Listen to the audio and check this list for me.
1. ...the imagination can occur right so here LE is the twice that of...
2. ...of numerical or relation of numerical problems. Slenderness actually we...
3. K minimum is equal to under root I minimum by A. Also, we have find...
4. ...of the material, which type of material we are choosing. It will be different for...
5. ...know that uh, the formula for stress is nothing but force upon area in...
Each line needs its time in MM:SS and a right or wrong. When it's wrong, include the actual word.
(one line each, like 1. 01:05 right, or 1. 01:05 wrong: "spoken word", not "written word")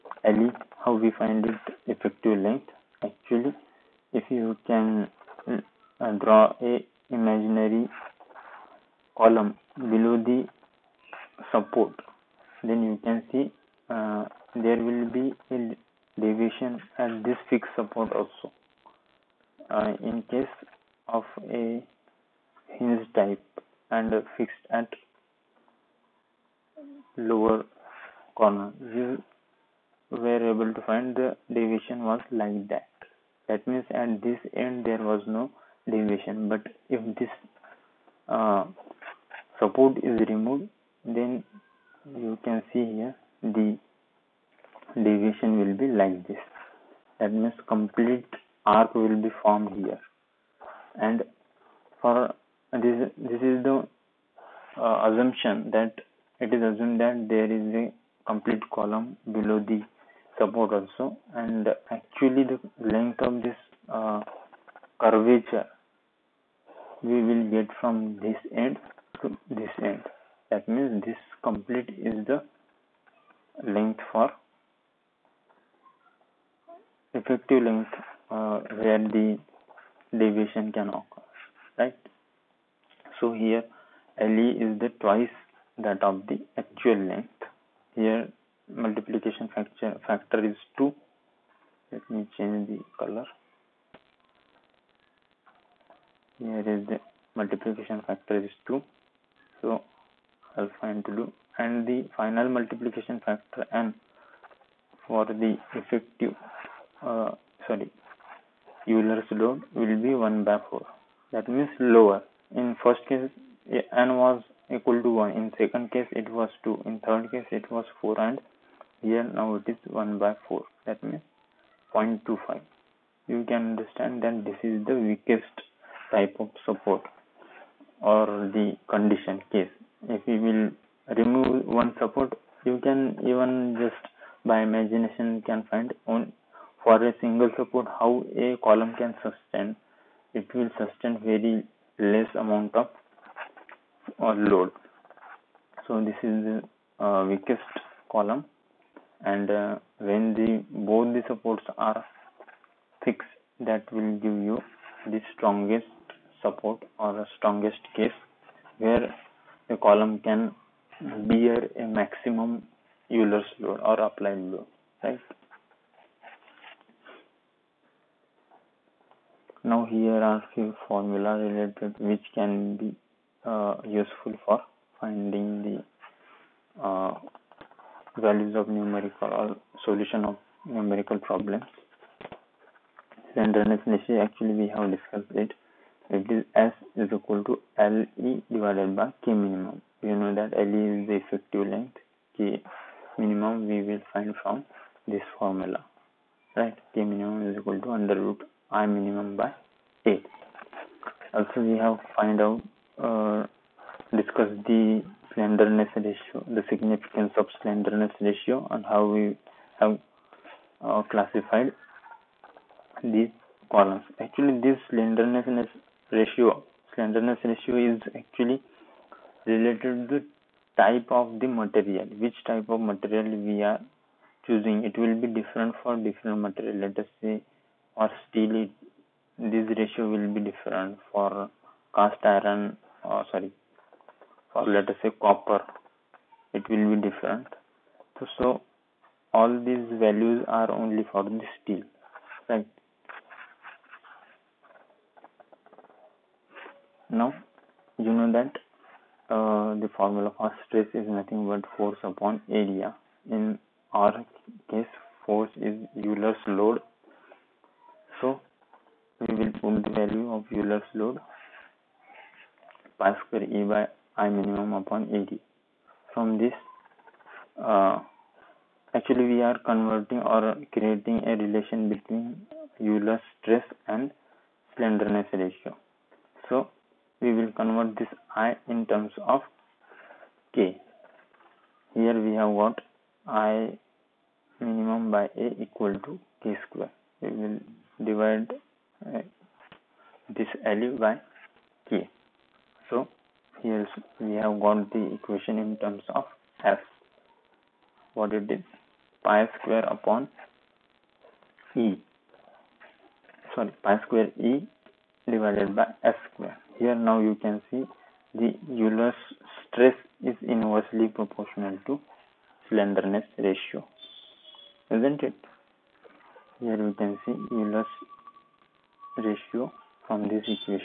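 1. 01:19 wrong: "deviation", not "imagination"
2. 02:58 wrong: "solution", not "relation"
3. 03:16 right
4. 03:41 right
5. 04:08 right.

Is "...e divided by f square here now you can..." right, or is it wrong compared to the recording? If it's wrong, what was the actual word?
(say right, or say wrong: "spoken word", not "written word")
right.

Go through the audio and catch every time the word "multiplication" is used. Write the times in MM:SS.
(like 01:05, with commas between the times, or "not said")
01:28, 01:37, 01:42.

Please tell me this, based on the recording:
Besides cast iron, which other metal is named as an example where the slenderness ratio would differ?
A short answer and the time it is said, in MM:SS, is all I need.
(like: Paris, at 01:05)
Copper, at 03:55.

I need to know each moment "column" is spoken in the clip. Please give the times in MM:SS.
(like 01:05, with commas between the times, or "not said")
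00:09, 02:18, 02:28, 02:39, 03:33.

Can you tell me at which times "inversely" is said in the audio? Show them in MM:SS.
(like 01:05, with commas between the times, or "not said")
05:10.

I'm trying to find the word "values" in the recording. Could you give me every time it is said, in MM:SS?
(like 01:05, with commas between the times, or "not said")
02:58, 03:59, 04:19, 04:50.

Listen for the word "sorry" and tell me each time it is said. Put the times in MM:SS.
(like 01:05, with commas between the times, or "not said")
01:47, 03:53, 05:03.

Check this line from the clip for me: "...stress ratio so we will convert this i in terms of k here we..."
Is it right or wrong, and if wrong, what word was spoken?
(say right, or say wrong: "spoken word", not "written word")
wrong: "slenderness", not "stress".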